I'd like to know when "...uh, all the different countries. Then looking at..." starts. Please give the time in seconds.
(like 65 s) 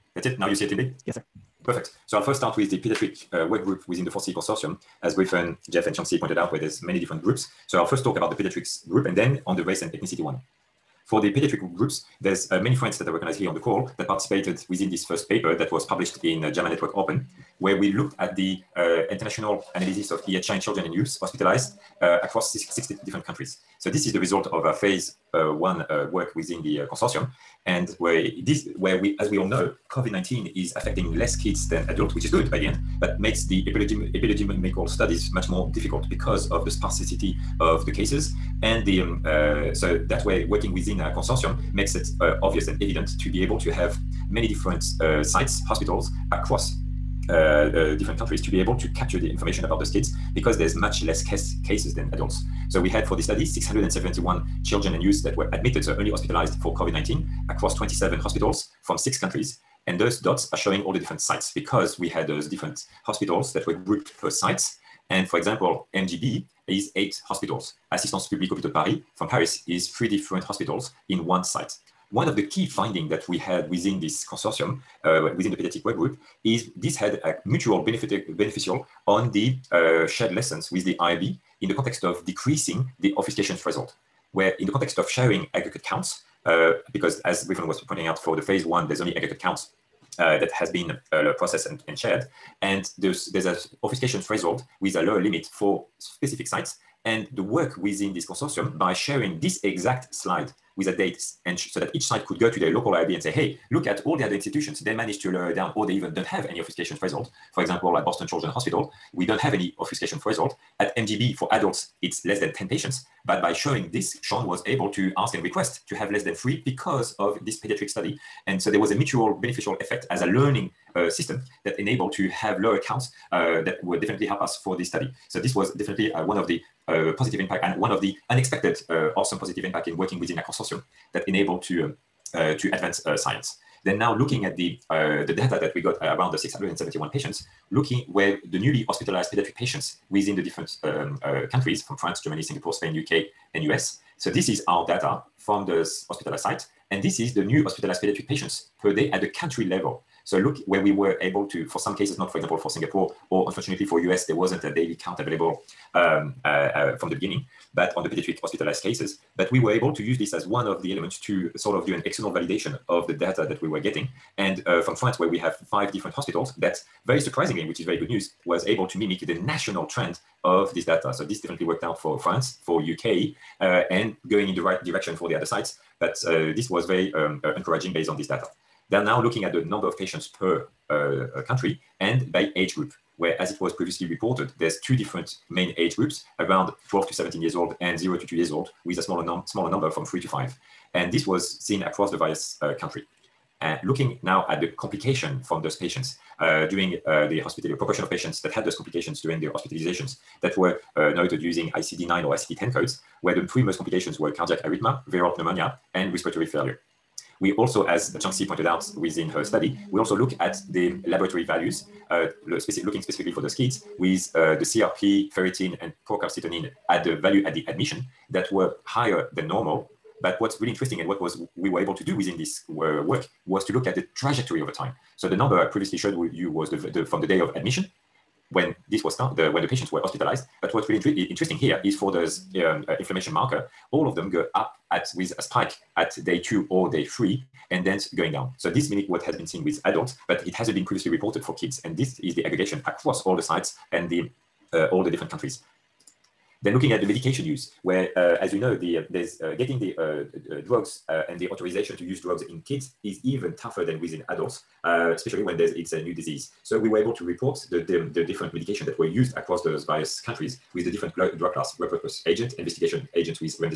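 244 s.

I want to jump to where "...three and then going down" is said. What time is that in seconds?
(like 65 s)
237 s.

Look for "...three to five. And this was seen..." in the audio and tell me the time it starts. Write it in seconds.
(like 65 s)
190 s.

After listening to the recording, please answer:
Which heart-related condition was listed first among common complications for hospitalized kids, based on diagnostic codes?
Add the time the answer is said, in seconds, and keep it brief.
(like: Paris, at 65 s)
Cardiac arrhythmia, at 204 s.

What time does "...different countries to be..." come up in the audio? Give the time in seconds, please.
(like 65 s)
47 s.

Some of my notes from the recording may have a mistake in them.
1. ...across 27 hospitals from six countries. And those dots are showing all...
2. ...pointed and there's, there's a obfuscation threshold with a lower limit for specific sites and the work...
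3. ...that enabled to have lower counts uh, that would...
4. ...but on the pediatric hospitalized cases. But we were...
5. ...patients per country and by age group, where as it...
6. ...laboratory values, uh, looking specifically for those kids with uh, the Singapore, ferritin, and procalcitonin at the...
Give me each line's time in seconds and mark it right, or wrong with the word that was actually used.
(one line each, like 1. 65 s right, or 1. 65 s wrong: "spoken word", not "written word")
1. 57 s right
2. 91 s wrong: "shared", not "pointed"
3. 121 s right
4. 157 s right
5. 179 s right
6. 211 s wrong: "CRP", not "Singapore".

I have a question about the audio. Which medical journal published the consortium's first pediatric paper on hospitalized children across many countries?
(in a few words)
JAMA Network Open.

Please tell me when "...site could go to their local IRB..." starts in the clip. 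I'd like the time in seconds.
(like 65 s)
102 s.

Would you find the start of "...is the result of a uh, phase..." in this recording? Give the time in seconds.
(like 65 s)
24 s.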